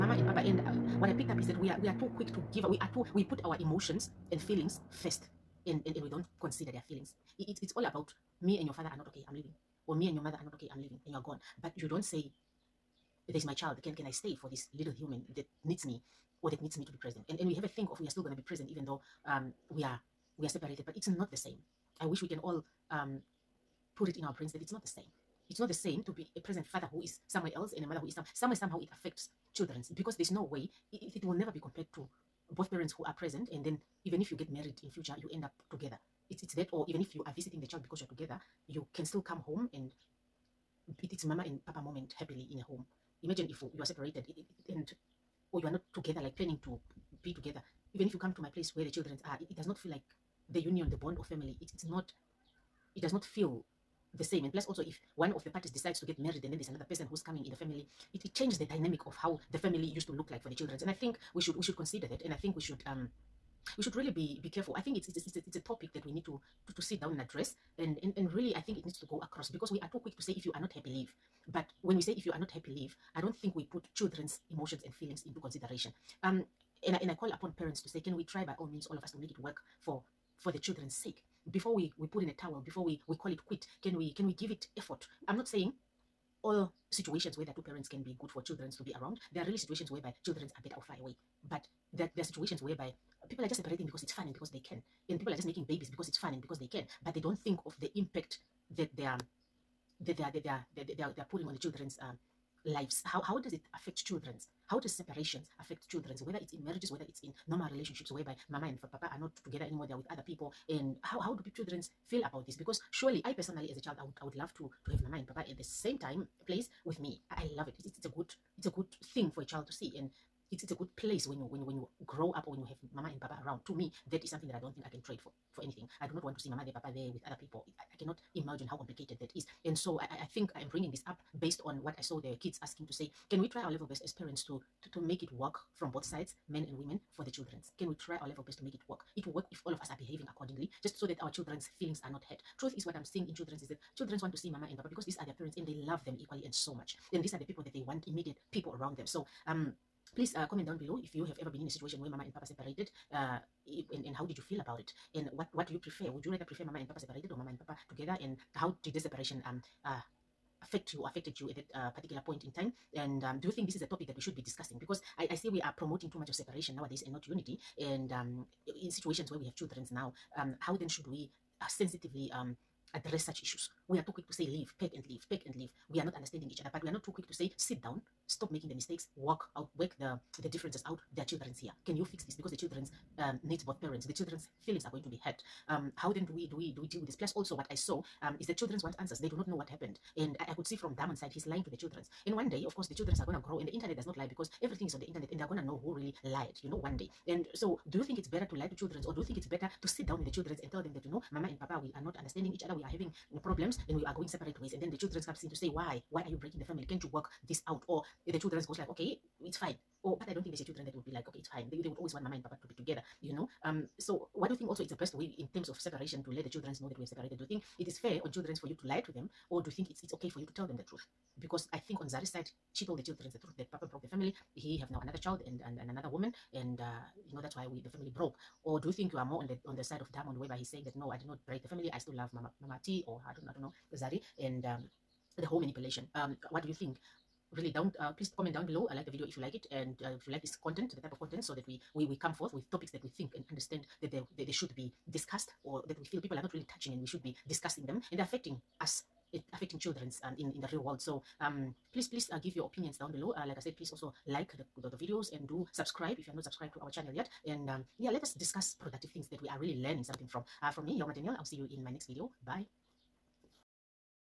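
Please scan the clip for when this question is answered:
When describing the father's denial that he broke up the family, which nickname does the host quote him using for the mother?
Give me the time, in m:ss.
3:52.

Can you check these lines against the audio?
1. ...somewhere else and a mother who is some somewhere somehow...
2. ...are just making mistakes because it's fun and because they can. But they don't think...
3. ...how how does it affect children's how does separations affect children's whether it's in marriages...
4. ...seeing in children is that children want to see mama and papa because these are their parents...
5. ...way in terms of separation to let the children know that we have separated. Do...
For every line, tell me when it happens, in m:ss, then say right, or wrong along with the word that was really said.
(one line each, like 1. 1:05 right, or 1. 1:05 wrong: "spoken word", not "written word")
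1. 0:27 right
2. 1:35 wrong: "babies", not "mistakes"
3. 1:43 right
4. 2:23 right
5. 3:35 right.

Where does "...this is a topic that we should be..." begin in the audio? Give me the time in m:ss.
2:43.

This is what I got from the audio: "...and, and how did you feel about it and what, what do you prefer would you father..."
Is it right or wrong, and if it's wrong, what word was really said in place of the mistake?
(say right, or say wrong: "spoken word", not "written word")
wrong: "rather", not "father".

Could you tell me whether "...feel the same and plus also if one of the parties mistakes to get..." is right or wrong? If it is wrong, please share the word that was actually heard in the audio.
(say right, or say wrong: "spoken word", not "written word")
wrong: "decides", not "mistakes".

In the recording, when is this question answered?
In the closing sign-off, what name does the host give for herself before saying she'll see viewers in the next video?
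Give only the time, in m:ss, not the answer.
4:20.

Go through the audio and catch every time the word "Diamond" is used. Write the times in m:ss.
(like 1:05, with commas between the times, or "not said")
3:10, 3:50.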